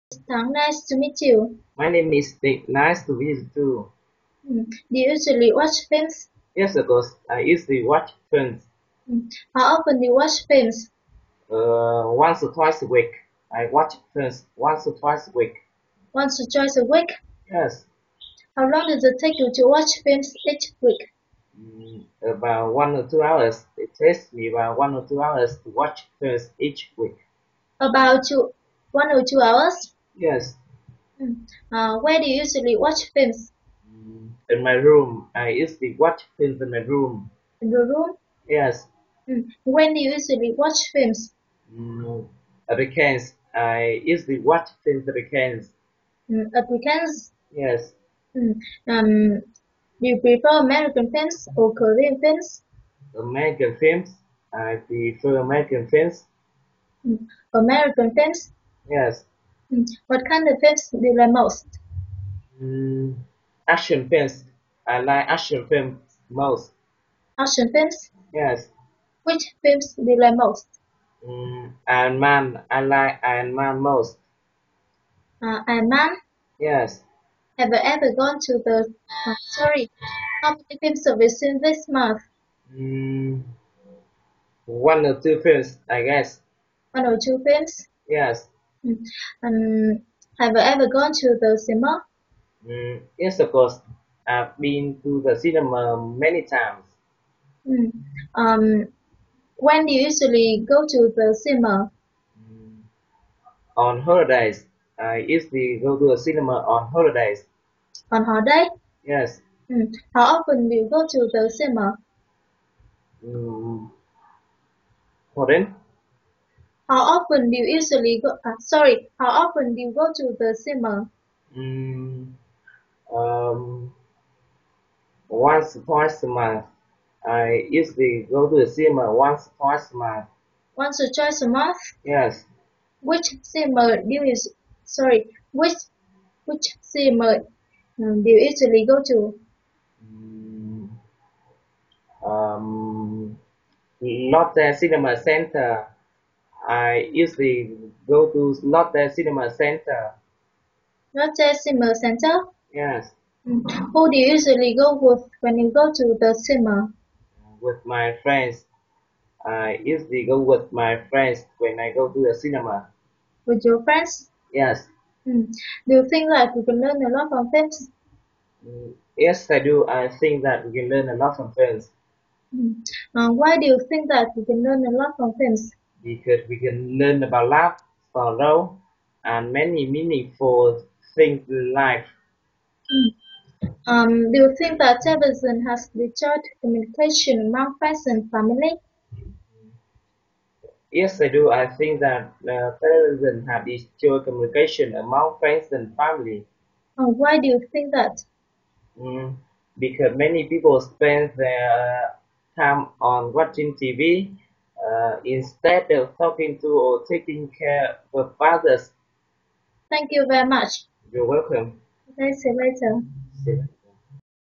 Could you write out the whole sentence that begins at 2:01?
Mm, um, once twice a month.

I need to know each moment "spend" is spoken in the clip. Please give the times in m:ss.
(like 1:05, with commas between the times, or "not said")
3:20.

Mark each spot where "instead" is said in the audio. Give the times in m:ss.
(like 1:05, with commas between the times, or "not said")
3:25.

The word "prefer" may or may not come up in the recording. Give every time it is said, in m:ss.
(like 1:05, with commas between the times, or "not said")
0:50, 0:54.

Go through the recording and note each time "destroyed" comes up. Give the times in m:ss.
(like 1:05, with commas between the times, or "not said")
3:05, 3:13.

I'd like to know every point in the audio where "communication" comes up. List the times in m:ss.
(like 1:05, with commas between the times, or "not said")
3:06, 3:14.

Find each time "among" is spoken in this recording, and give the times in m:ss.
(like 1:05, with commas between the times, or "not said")
3:07, 3:14.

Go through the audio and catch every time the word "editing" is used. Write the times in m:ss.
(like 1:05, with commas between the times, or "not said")
not said.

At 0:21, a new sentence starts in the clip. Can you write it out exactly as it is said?
Mm, about one or two hours.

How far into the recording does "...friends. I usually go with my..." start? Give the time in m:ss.
2:38.